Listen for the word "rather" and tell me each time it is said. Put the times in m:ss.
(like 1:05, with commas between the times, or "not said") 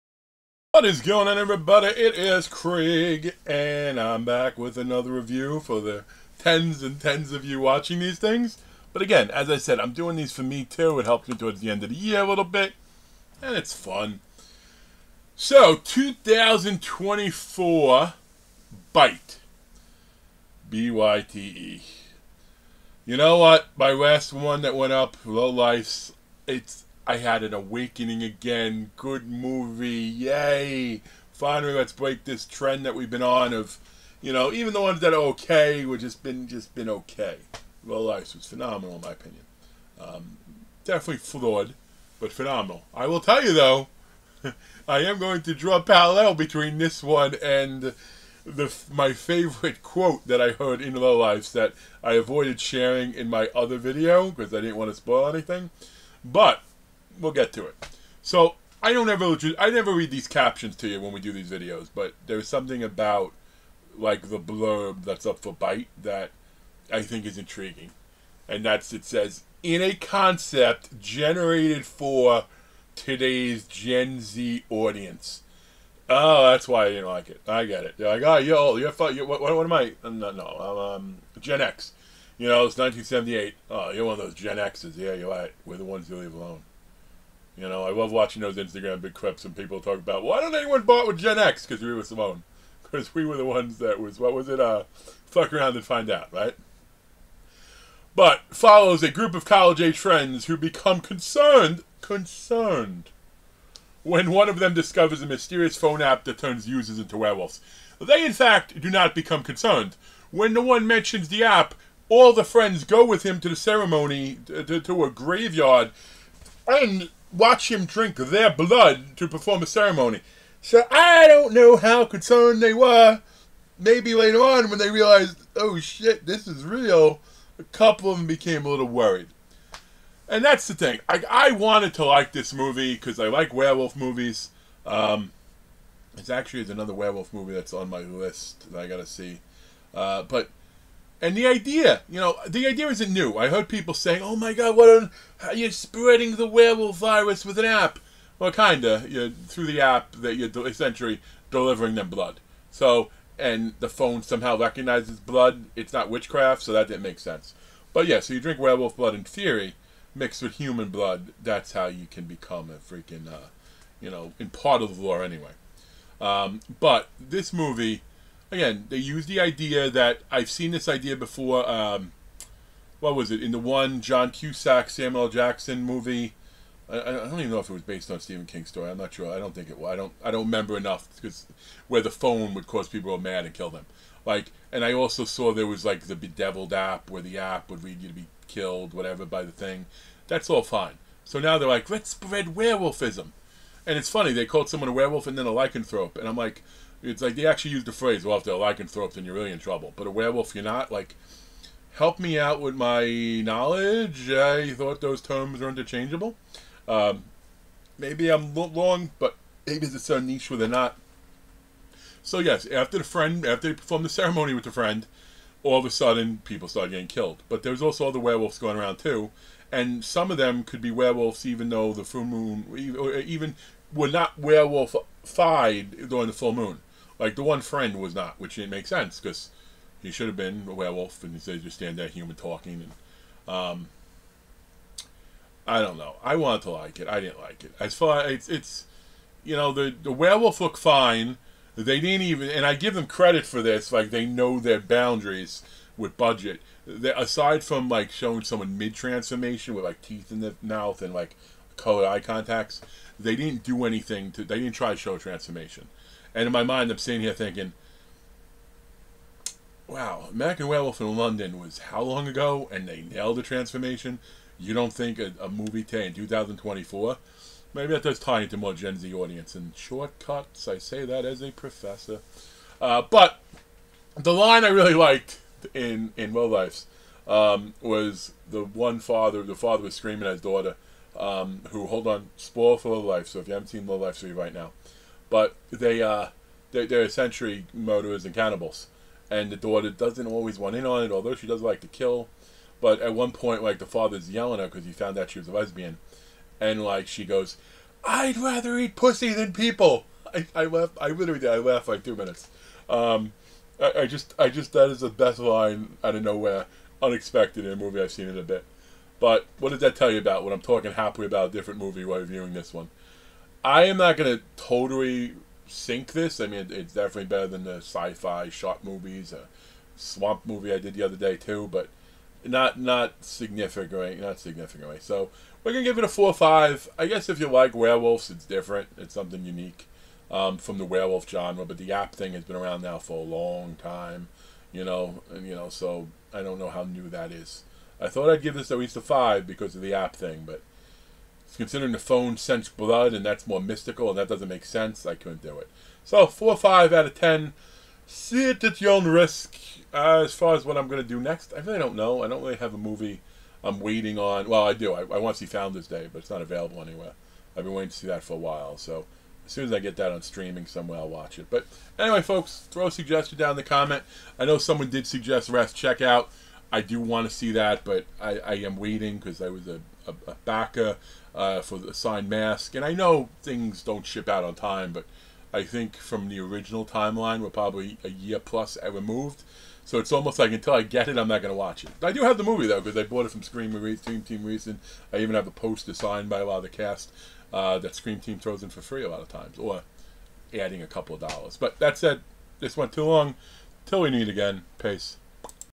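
4:58.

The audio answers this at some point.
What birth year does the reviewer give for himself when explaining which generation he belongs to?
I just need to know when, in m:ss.
1:22.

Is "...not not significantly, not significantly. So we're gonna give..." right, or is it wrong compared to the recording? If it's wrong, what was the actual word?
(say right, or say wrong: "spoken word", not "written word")
right.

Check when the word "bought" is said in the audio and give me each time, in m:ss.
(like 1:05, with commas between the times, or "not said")
1:30, 6:23.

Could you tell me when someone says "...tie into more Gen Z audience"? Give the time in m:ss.
4:28.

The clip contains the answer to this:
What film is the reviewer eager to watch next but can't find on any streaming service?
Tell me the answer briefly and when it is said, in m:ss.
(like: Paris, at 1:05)
Founders Day, at 5:55.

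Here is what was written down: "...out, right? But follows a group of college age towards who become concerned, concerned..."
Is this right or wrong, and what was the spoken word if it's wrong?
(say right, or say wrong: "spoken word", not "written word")
wrong: "friends", not "towards".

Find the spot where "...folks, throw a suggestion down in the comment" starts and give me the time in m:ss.
6:02.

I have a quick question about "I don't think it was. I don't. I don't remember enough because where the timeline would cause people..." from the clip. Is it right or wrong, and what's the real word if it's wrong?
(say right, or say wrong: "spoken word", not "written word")
wrong: "phone", not "timeline".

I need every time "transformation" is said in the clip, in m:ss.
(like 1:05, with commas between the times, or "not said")
4:08, 4:15, 4:23.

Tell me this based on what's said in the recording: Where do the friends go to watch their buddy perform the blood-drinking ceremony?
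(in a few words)
A graveyard.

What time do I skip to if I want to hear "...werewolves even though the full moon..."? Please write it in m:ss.
3:40.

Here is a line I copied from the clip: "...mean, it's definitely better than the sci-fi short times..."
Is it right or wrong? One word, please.
wrong.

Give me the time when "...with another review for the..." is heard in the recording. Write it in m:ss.
0:04.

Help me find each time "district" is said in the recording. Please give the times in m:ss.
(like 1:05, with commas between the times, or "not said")
not said.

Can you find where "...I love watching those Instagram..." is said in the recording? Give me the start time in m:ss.
1:27.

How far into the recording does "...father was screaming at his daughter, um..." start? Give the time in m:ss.
4:39.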